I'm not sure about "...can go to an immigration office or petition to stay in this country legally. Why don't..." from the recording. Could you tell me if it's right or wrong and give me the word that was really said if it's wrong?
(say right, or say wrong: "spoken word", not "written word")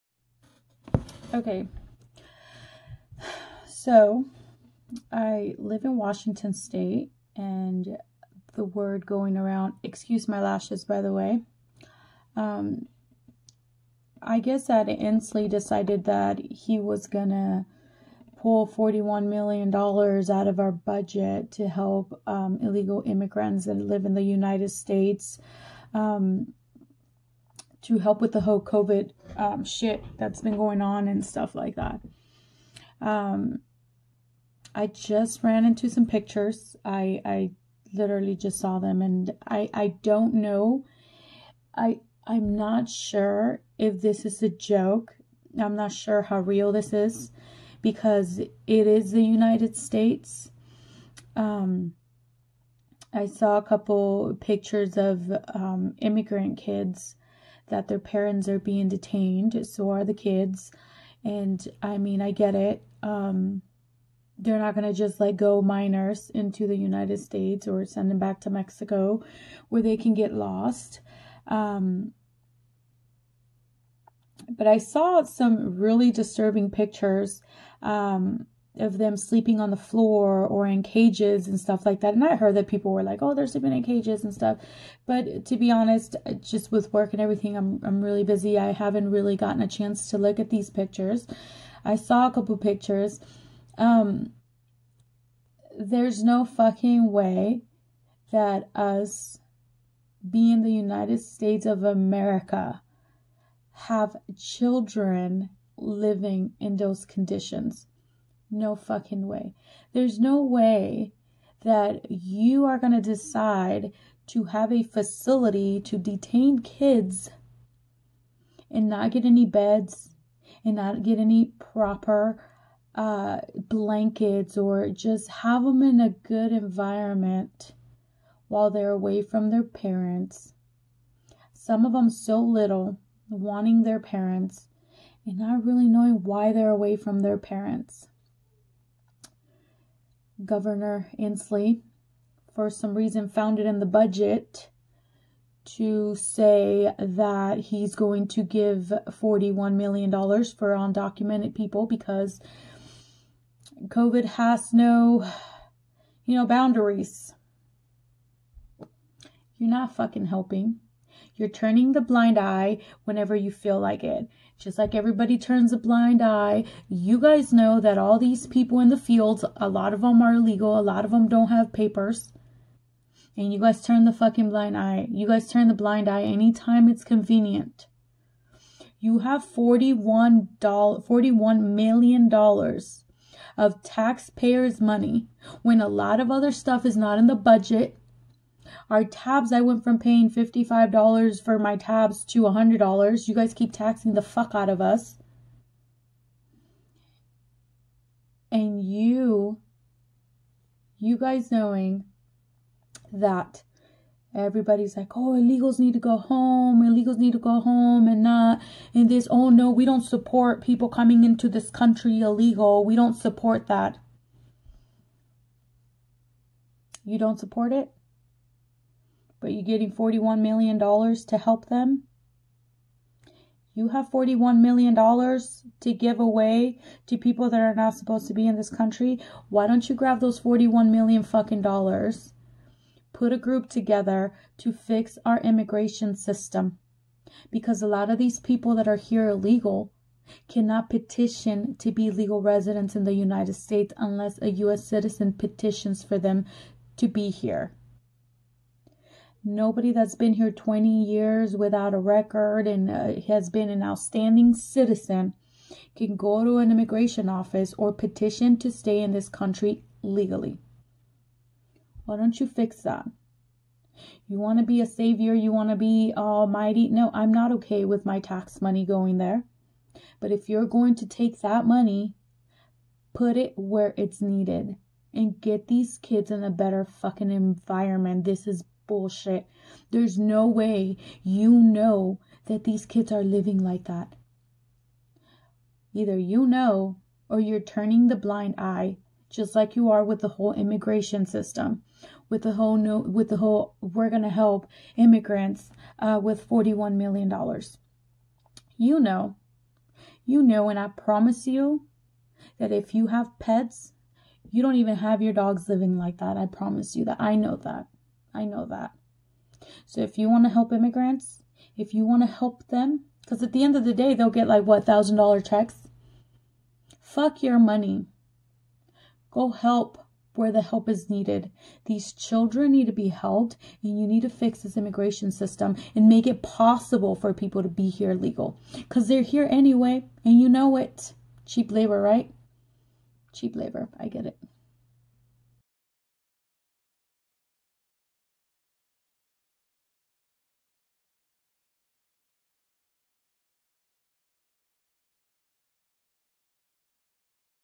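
right.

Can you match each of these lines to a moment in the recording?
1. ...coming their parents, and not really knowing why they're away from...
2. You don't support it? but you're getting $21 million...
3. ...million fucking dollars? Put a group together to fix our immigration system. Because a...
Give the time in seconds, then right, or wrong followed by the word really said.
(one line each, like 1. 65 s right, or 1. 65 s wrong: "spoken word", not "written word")
1. 133 s wrong: "wanting", not "coming"
2. 217 s wrong: "41", not "21"
3. 230 s right.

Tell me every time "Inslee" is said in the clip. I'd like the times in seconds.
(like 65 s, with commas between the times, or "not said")
14 s, 141 s.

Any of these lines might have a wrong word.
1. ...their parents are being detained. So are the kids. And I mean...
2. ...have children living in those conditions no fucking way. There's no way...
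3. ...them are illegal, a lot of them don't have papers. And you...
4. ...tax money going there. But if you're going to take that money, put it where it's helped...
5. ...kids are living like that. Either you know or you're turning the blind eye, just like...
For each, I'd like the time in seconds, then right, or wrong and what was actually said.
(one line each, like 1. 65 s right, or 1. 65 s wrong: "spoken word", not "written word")
1. 57 s right
2. 103 s right
3. 170 s right
4. 268 s wrong: "needed", not "helped"
5. 282 s right.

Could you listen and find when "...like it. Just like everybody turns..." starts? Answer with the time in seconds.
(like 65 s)
163 s.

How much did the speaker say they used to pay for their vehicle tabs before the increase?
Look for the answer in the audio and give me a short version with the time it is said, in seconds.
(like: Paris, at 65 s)
$55, at 190 s.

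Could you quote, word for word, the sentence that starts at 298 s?
You know, you know, and I promise you that if you have pets, you don't even have your dogs living like that.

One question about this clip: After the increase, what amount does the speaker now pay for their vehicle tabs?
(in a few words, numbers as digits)
$100.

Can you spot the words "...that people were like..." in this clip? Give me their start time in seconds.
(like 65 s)
82 s.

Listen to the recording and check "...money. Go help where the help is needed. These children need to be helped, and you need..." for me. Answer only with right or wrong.
right.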